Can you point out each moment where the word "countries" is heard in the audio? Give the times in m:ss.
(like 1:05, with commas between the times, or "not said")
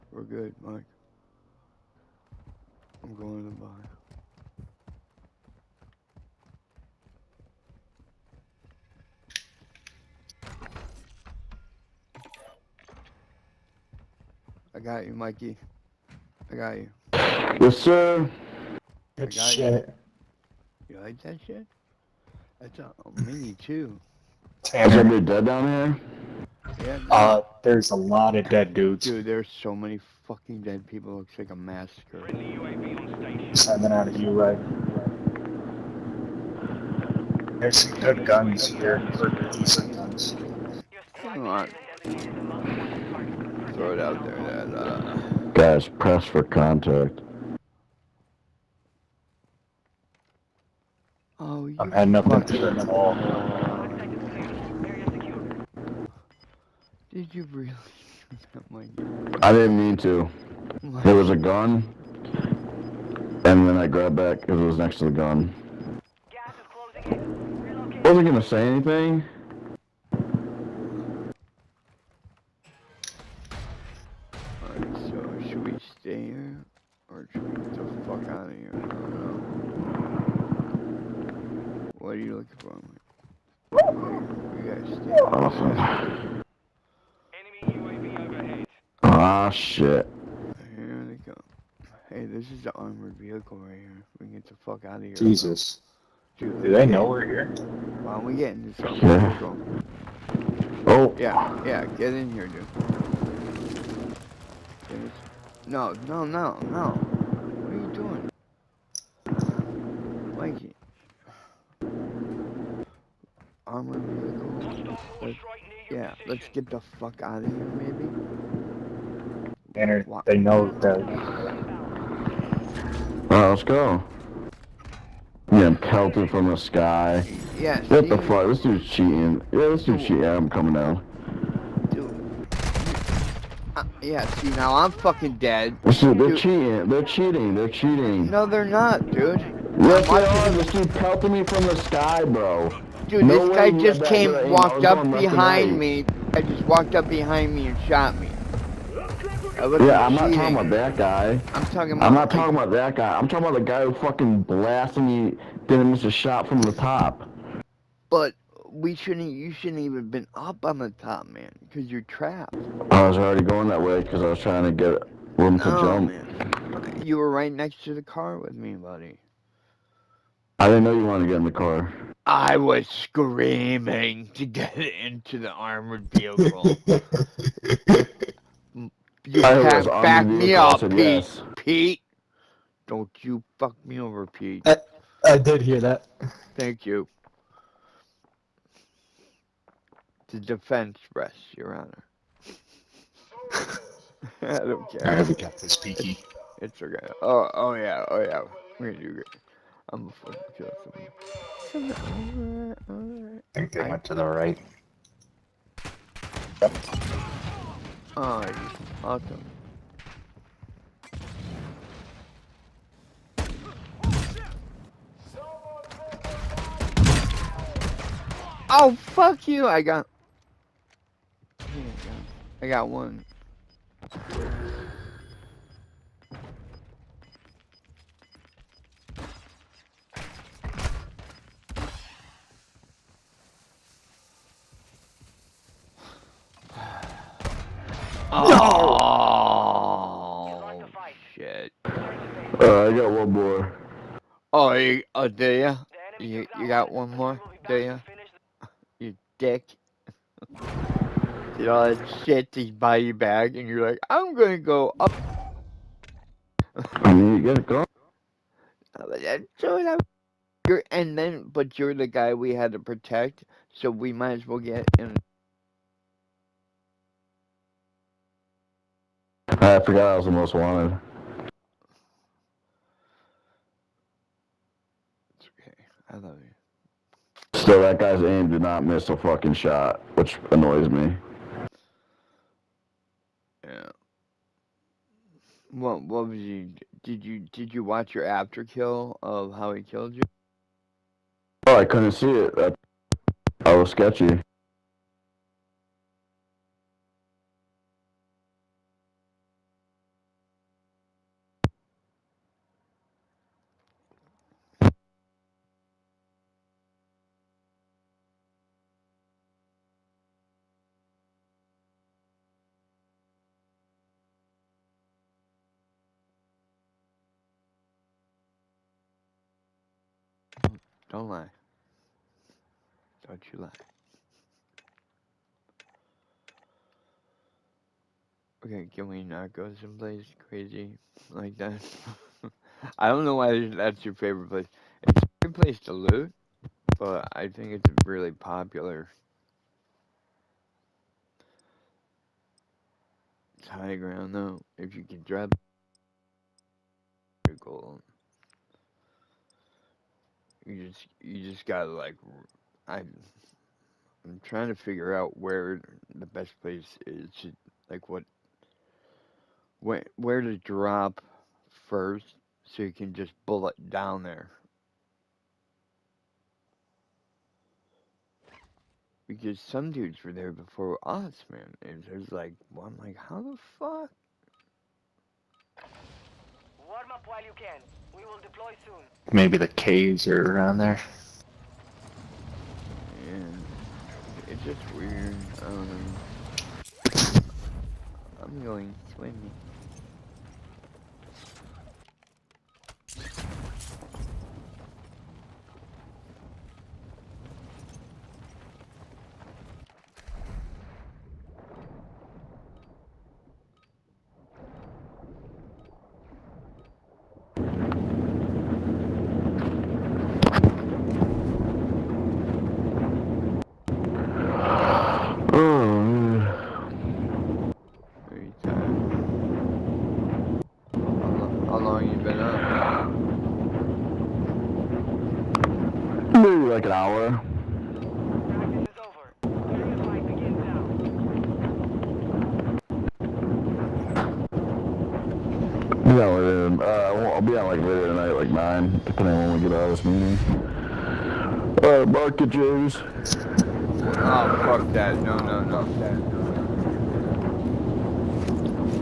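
not said.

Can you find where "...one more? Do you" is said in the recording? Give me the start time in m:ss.
4:06.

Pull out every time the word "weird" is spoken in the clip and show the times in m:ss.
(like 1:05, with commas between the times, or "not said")
6:24.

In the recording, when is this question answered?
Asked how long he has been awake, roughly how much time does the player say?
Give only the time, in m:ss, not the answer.
7:06.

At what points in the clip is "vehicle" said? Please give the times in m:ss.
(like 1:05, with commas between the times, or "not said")
1:33, 1:39, 1:54, 2:56.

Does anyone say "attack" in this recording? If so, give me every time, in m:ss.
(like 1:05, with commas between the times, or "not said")
not said.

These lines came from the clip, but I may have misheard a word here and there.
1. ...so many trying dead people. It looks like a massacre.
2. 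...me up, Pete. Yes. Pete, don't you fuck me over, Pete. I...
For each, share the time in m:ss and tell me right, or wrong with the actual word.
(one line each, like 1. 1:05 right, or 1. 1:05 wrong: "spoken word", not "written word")
1. 0:29 wrong: "fucking", not "trying"
2. 3:00 right.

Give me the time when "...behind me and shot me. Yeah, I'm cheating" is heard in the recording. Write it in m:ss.
2:27.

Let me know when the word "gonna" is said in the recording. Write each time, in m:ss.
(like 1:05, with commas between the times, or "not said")
1:08, 3:18, 4:14.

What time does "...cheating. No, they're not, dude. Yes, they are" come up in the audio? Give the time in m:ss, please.
2:17.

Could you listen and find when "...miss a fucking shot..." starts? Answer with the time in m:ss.
4:38.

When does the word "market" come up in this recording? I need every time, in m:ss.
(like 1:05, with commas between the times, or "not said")
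7:22.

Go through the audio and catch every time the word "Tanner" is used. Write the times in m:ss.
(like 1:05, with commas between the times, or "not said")
1:59.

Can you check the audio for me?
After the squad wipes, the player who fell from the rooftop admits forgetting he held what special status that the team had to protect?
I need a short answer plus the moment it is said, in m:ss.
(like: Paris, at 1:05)
most wanted, at 4:30.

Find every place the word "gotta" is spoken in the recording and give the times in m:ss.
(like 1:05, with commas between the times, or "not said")
1:24, 4:17, 5:51.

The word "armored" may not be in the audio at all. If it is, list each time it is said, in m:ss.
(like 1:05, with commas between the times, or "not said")
1:32, 1:38, 1:53, 2:55.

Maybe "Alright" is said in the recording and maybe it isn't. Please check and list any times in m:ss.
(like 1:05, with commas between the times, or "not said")
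1:14, 2:03, 7:21.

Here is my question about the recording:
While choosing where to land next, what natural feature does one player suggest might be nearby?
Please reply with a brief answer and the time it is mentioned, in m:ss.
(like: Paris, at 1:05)
the caves, at 6:19.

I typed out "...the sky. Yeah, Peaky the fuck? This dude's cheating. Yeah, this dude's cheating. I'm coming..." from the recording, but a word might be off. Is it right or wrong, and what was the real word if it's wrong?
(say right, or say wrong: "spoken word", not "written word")
wrong: "What", not "Peaky".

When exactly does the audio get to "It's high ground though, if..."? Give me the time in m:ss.
5:43.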